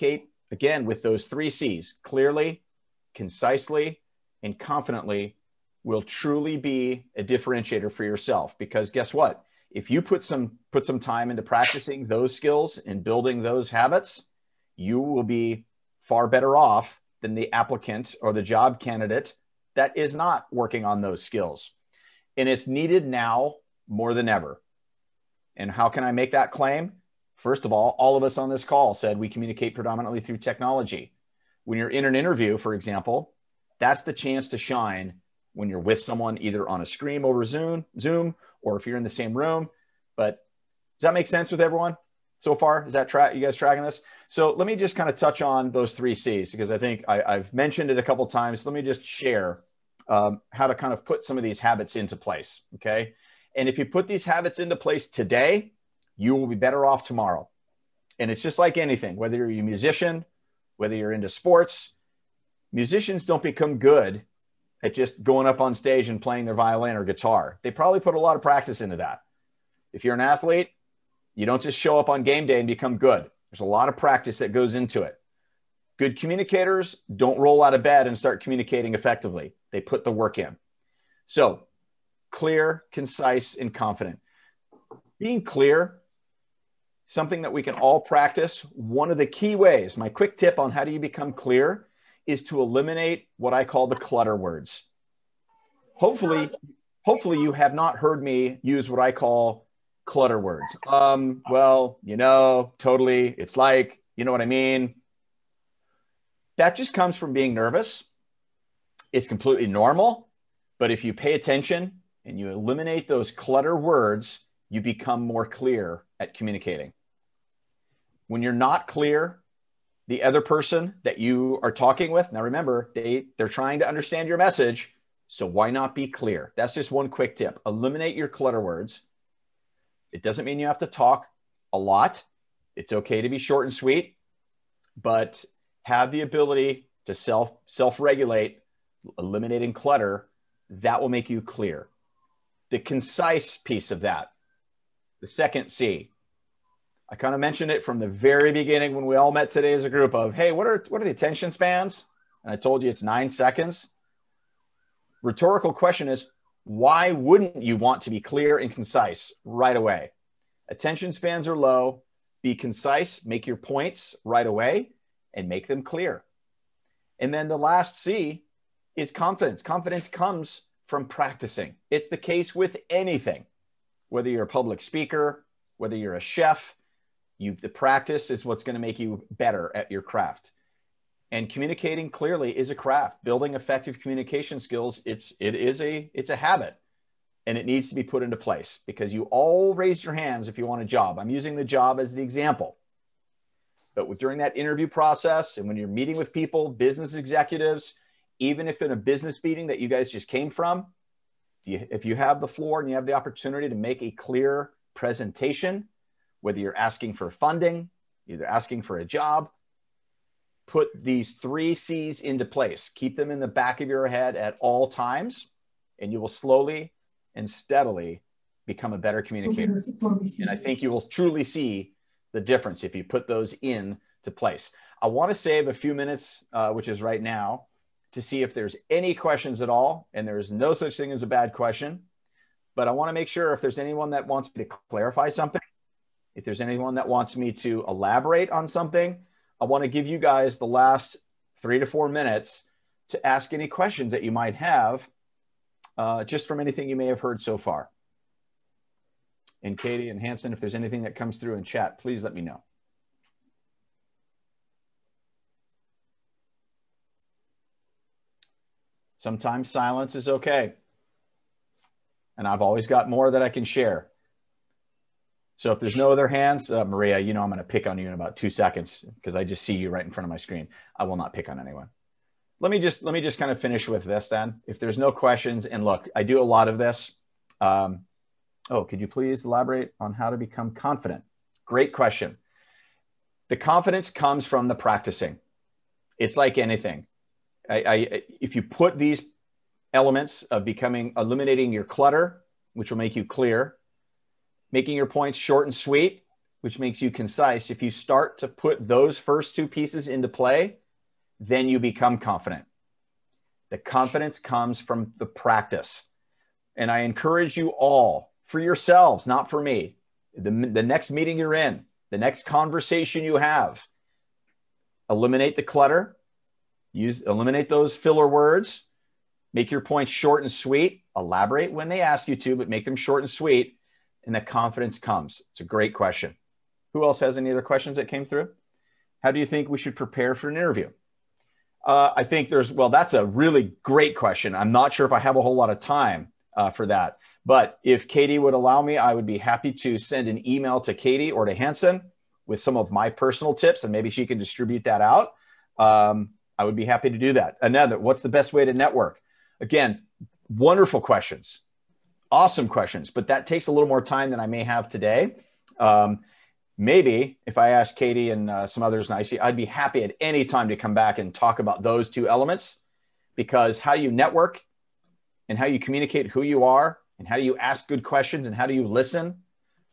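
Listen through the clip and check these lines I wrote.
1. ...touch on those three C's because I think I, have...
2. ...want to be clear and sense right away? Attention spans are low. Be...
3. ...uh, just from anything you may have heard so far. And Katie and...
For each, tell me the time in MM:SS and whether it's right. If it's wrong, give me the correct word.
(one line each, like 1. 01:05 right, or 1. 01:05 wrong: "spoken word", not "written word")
1. 00:45 right
2. 02:37 wrong: "concise", not "sense"
3. 04:05 right.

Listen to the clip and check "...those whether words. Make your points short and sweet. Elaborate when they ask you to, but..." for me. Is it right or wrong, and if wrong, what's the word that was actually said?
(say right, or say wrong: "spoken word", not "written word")
wrong: "filler", not "whether".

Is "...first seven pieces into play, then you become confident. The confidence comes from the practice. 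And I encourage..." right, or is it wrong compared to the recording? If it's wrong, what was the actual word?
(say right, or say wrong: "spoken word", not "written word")
wrong: "two", not "seven".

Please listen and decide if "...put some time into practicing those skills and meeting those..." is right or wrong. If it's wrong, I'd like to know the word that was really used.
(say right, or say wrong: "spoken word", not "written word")
wrong: "building", not "meeting".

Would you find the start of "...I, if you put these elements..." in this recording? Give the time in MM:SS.
04:47.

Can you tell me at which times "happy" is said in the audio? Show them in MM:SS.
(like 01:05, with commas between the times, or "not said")
05:39, 05:46, 05:59.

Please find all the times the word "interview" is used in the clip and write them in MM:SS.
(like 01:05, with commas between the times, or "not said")
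00:32, 03:14, 05:30.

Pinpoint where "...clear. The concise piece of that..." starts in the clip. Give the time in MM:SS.
02:21.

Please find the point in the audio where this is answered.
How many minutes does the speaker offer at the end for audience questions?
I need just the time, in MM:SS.
04:01.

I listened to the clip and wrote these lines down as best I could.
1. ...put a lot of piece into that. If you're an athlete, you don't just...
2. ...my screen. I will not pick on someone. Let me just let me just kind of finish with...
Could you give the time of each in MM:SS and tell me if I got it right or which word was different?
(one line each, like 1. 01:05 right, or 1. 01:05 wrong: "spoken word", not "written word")
1. 01:07 wrong: "practice", not "piece"
2. 04:30 wrong: "anyone", not "someone".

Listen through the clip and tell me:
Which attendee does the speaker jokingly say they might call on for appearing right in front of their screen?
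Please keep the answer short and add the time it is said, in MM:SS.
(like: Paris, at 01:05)
Maria, at 04:26.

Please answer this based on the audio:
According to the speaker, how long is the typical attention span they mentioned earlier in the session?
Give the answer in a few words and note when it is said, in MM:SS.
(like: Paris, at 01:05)
9 seconds, at 02:33.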